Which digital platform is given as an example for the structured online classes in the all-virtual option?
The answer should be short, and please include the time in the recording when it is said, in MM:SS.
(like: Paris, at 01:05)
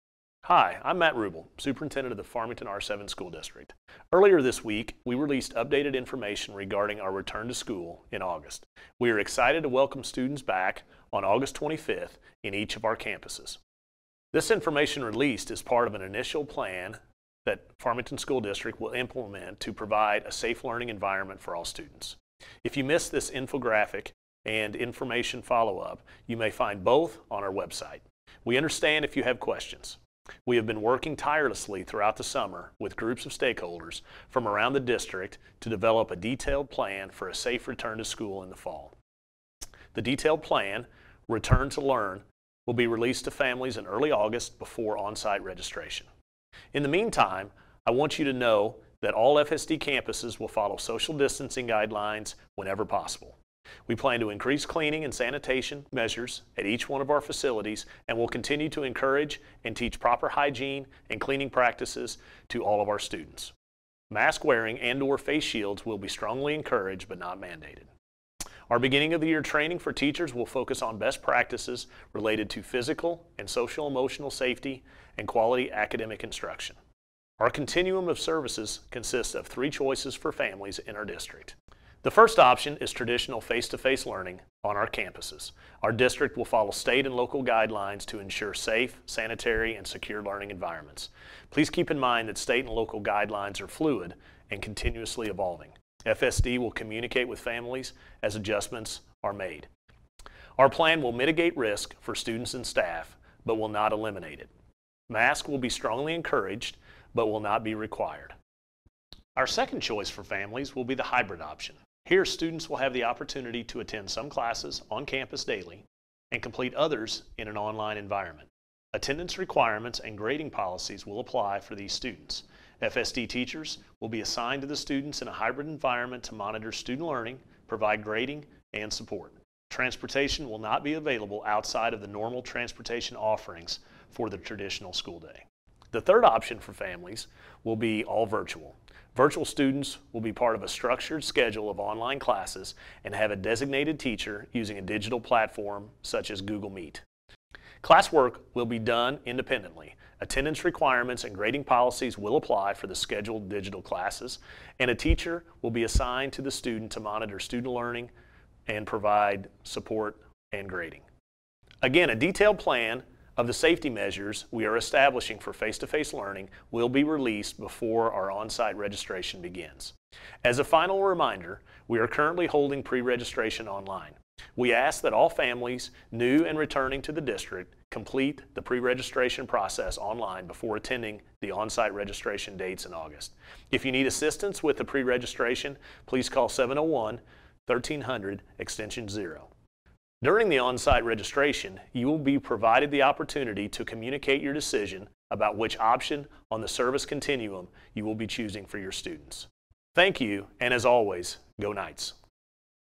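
Google Meet, at 02:26.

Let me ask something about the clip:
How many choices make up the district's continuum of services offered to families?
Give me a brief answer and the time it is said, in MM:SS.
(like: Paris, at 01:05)
3, at 01:19.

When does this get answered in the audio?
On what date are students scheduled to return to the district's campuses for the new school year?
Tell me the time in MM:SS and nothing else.
00:11.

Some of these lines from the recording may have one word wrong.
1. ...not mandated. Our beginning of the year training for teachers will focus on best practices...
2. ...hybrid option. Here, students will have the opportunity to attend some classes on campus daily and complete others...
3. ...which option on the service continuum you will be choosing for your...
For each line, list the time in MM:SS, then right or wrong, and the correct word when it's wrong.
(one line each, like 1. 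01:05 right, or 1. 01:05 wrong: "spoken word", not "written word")
1. 01:07 right
2. 01:51 right
3. 03:15 right.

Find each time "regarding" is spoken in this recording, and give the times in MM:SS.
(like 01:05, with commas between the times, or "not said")
00:06.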